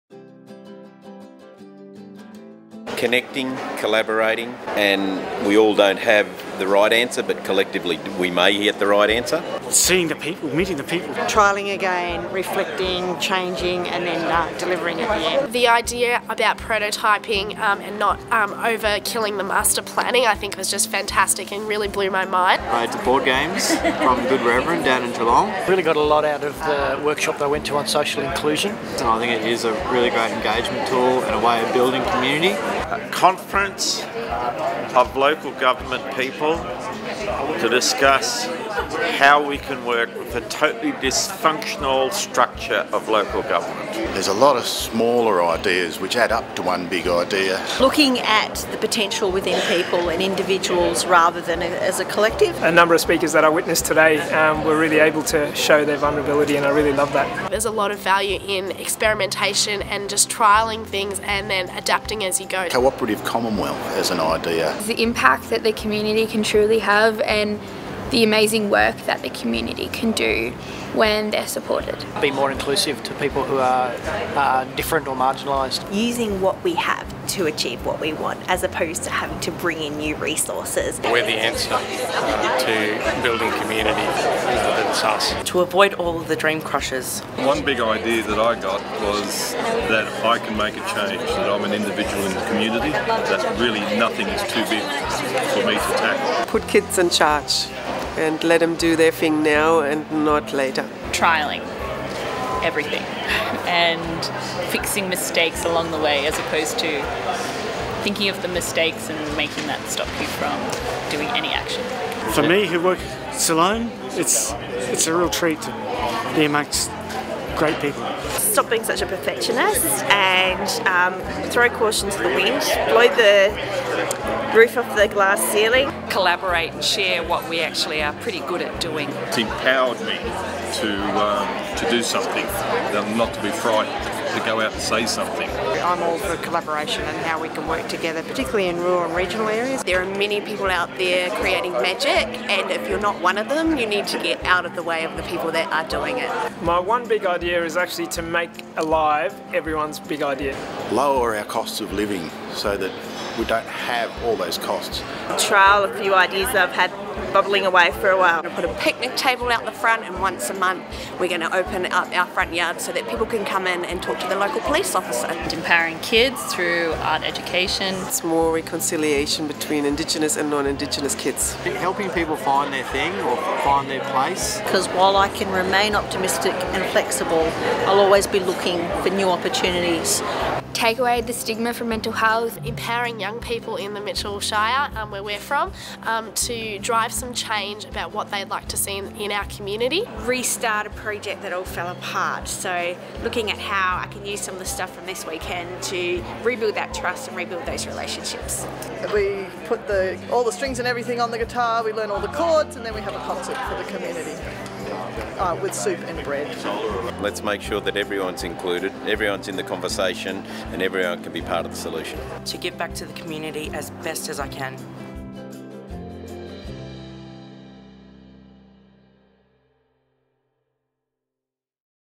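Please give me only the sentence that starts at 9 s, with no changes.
Seeing the people, meeting the people.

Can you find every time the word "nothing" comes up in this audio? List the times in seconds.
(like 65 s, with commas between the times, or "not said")
93 s.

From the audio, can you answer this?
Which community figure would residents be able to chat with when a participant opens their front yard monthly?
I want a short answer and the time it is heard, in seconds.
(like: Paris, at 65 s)
local police officer, at 164 s.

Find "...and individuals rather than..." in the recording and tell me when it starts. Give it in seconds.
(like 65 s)
50 s.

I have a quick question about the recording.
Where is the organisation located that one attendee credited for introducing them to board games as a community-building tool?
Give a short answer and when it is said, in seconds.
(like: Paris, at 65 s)
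Geelong, at 25 s.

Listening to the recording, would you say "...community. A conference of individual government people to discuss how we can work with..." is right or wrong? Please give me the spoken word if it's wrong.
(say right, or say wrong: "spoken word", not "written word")
wrong: "local", not "individual".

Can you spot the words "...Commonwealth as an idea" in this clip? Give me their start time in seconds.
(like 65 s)
63 s.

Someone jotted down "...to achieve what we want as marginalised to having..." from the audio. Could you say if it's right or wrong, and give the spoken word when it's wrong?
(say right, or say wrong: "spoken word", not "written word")
wrong: "opposed", not "marginalised".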